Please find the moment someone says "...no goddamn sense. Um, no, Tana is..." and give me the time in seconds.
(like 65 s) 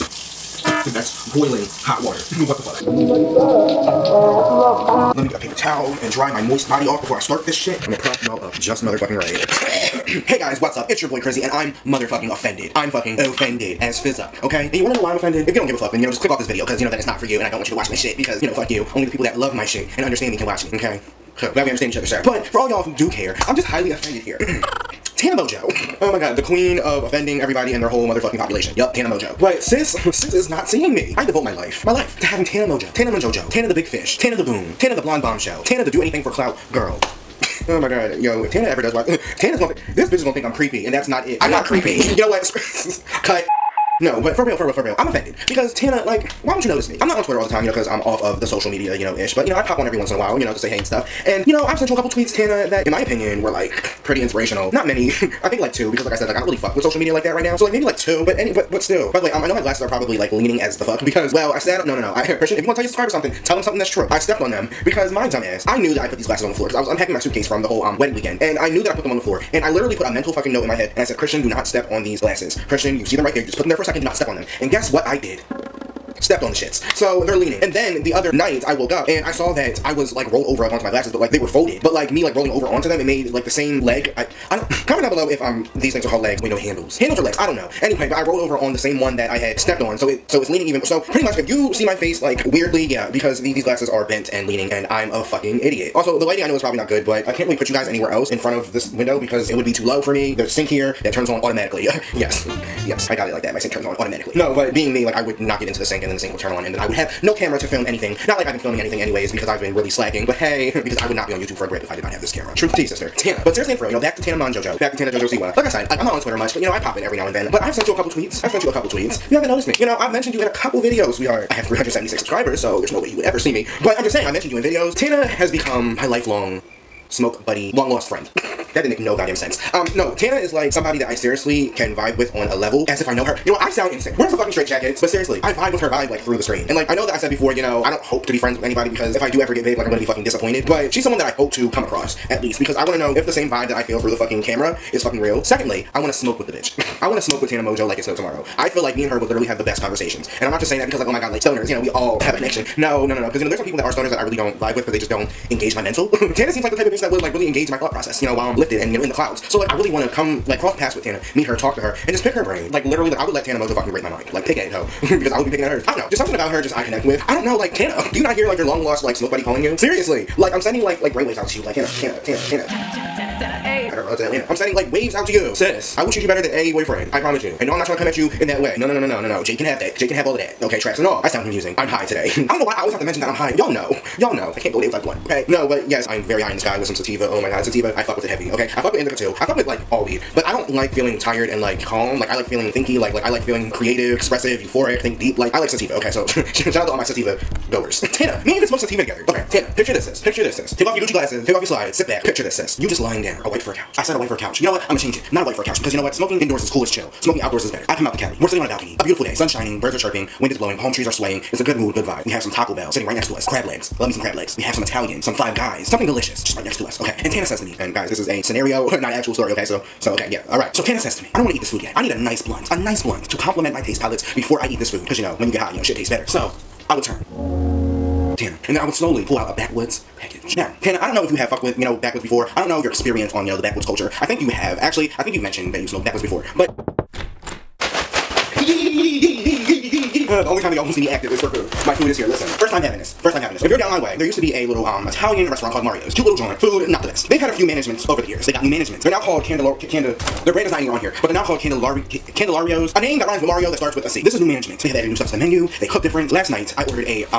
128 s.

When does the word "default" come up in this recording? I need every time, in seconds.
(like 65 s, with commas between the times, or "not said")
not said.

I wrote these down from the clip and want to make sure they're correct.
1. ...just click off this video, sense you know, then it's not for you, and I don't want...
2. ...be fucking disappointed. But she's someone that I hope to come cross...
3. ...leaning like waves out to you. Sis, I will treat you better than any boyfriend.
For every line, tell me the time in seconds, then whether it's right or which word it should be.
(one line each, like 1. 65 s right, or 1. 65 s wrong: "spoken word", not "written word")
1. 16 s wrong: "cause", not "sense"
2. 139 s wrong: "across", not "cross"
3. 174 s wrong: "sending", not "leaning".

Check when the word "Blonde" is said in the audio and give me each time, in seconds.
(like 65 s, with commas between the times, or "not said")
35 s.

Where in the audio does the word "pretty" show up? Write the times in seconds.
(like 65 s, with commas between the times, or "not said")
54 s, 91 s.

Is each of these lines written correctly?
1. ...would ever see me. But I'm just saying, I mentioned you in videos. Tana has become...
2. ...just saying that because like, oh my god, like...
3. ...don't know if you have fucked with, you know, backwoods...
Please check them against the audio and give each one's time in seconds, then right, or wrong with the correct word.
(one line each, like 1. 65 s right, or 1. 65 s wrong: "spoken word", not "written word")
1. 123 s right
2. 150 s right
3. 231 s right.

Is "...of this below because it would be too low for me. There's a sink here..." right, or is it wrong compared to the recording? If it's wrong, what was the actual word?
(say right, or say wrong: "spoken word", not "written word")
wrong: "window", not "below".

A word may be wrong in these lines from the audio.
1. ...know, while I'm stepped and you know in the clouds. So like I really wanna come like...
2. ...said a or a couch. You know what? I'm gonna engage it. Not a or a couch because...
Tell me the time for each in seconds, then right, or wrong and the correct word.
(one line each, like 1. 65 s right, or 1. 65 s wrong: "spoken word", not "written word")
1. 158 s wrong: "lifted", not "stepped"
2. 204 s wrong: "change", not "engage".